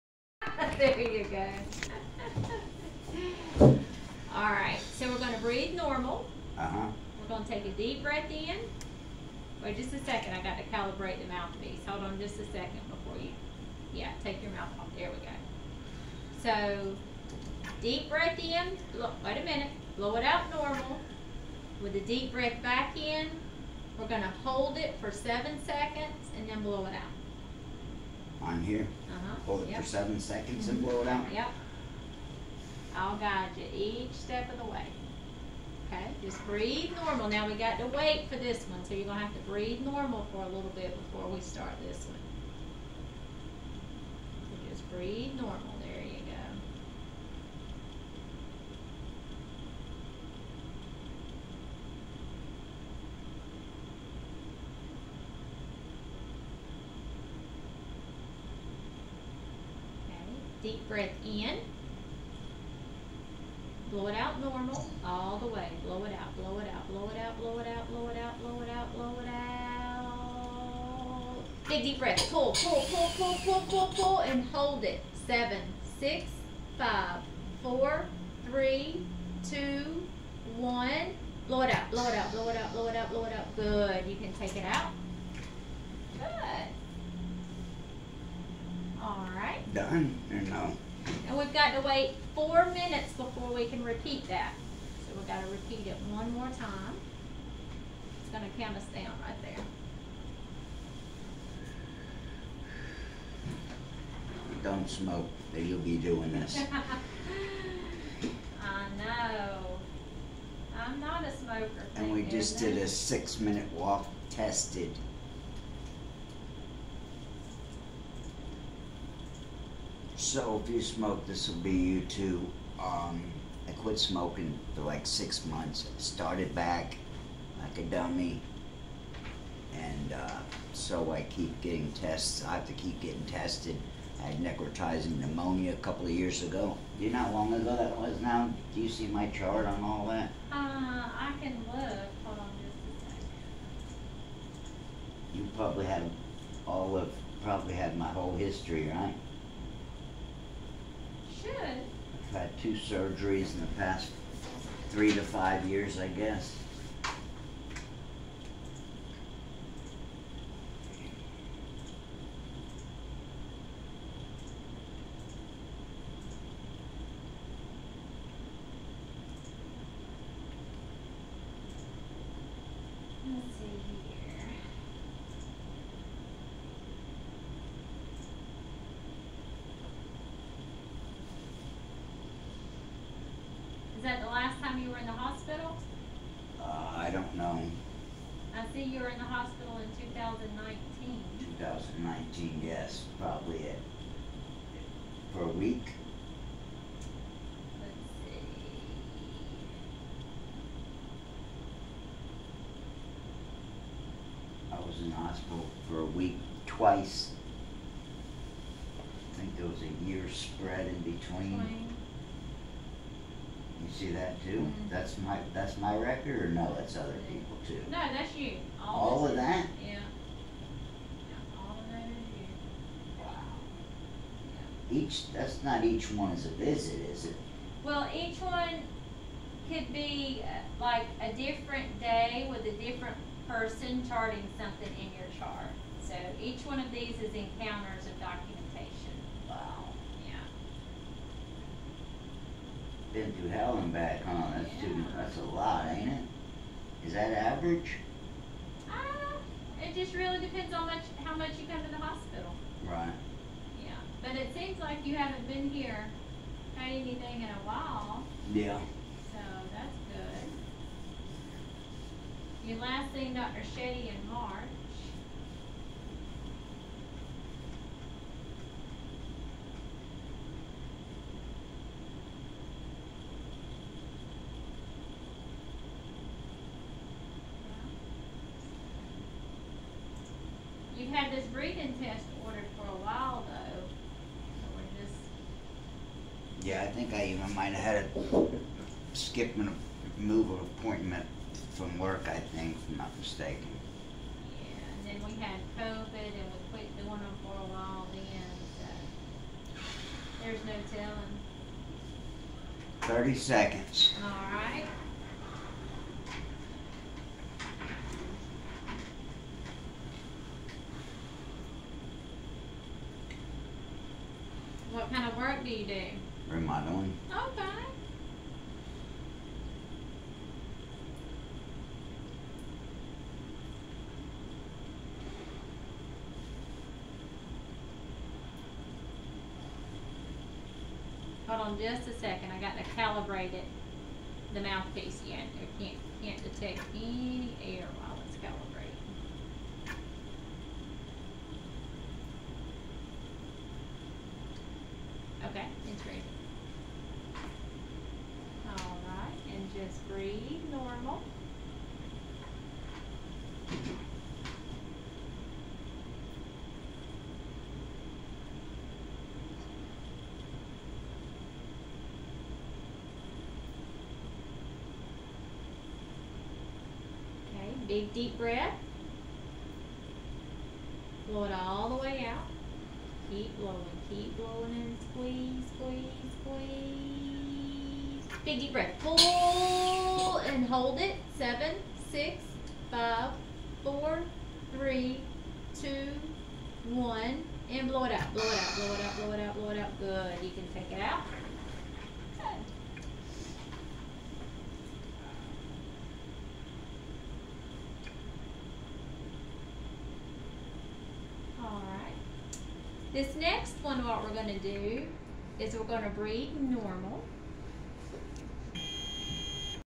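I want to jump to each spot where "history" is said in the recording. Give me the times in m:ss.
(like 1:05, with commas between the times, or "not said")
2:28.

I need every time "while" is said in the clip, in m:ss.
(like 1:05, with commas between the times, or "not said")
4:17, 4:43, 4:57, 5:37.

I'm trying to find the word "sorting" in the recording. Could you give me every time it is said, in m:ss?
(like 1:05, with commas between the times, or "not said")
not said.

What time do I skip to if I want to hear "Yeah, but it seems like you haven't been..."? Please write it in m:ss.
4:13.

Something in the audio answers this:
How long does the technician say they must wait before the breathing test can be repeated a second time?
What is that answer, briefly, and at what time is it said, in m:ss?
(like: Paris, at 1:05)
4 minutes, at 1:32.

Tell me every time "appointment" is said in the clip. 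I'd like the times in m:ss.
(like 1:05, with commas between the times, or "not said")
4:50.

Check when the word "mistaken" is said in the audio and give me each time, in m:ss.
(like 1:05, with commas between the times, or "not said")
4:53.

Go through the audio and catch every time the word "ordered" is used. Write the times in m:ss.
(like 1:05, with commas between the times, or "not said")
4:42.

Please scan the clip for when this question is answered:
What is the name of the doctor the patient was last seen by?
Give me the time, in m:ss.
4:23.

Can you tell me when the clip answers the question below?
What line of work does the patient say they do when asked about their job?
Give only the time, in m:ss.
5:16.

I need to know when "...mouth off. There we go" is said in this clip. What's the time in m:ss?
0:14.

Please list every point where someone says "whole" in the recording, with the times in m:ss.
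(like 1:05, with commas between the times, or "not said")
2:28.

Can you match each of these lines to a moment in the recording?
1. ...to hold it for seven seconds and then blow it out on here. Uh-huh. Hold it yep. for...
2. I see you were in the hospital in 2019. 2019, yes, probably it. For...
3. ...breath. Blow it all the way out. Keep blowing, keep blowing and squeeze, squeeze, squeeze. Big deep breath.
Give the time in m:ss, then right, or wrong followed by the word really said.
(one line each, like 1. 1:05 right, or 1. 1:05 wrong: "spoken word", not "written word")
1. 0:24 right
2. 3:08 right
3. 6:08 right.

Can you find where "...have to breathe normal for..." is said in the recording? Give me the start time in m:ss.
0:39.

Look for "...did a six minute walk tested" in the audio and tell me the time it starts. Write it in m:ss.
1:52.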